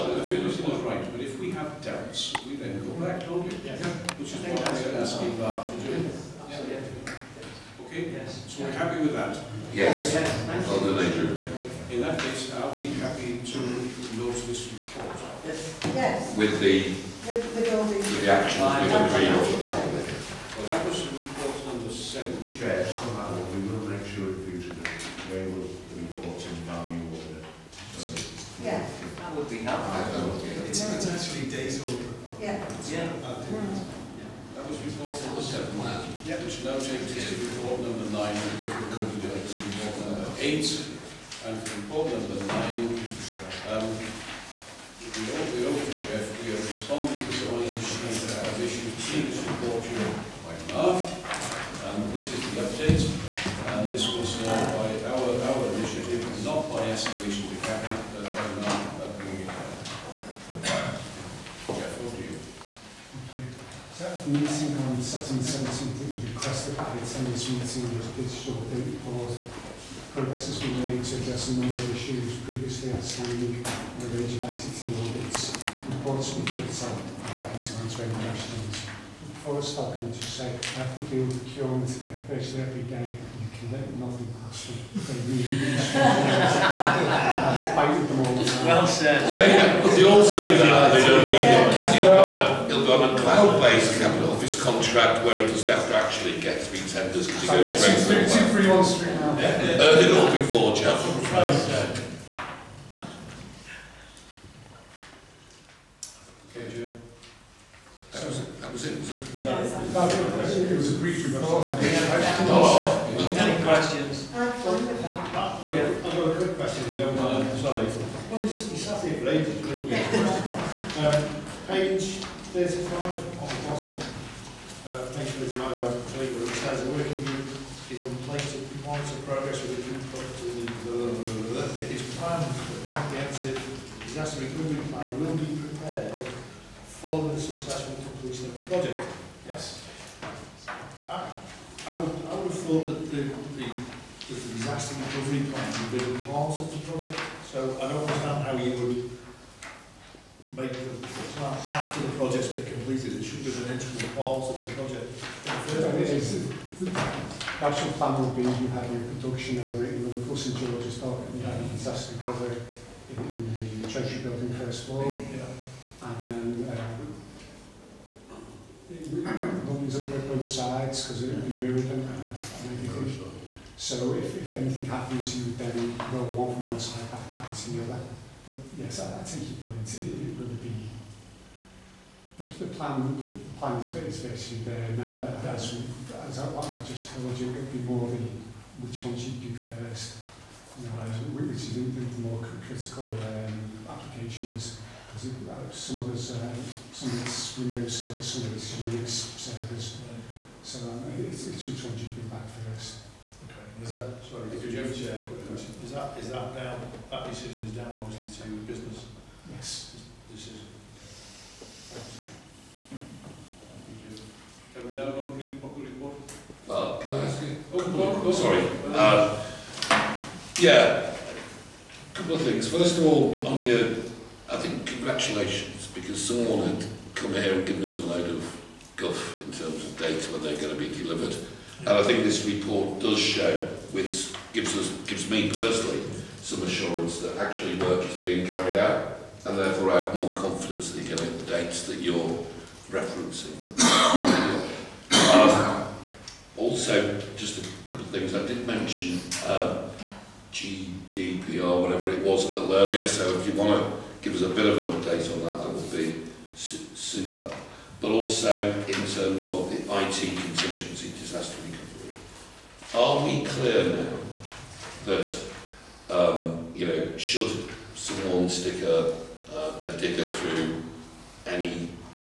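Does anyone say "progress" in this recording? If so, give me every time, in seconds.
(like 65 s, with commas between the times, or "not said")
70 s, 129 s.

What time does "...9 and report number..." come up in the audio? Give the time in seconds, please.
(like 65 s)
38 s.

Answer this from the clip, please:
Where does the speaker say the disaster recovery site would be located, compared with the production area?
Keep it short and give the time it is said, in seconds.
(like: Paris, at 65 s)
Treasury Building first floor, at 163 s.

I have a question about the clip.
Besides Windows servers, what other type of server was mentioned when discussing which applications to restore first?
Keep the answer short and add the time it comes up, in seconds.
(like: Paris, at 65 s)
Unix servers, at 198 s.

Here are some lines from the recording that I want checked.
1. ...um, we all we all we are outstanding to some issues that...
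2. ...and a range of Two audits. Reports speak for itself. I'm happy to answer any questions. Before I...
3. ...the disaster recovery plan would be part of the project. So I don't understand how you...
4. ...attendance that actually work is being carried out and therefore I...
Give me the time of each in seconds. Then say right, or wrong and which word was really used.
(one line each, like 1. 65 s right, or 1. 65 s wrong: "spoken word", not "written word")
1. 43 s wrong: "responding", not "outstanding"
2. 73 s wrong: "ICT", not "Two"
3. 144 s right
4. 236 s wrong: "assurance", not "attendance".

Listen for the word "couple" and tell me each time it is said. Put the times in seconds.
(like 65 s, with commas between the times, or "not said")
222 s, 247 s.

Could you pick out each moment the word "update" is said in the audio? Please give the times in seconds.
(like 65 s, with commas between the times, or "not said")
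52 s, 254 s.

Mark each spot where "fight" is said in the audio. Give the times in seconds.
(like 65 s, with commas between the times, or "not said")
87 s.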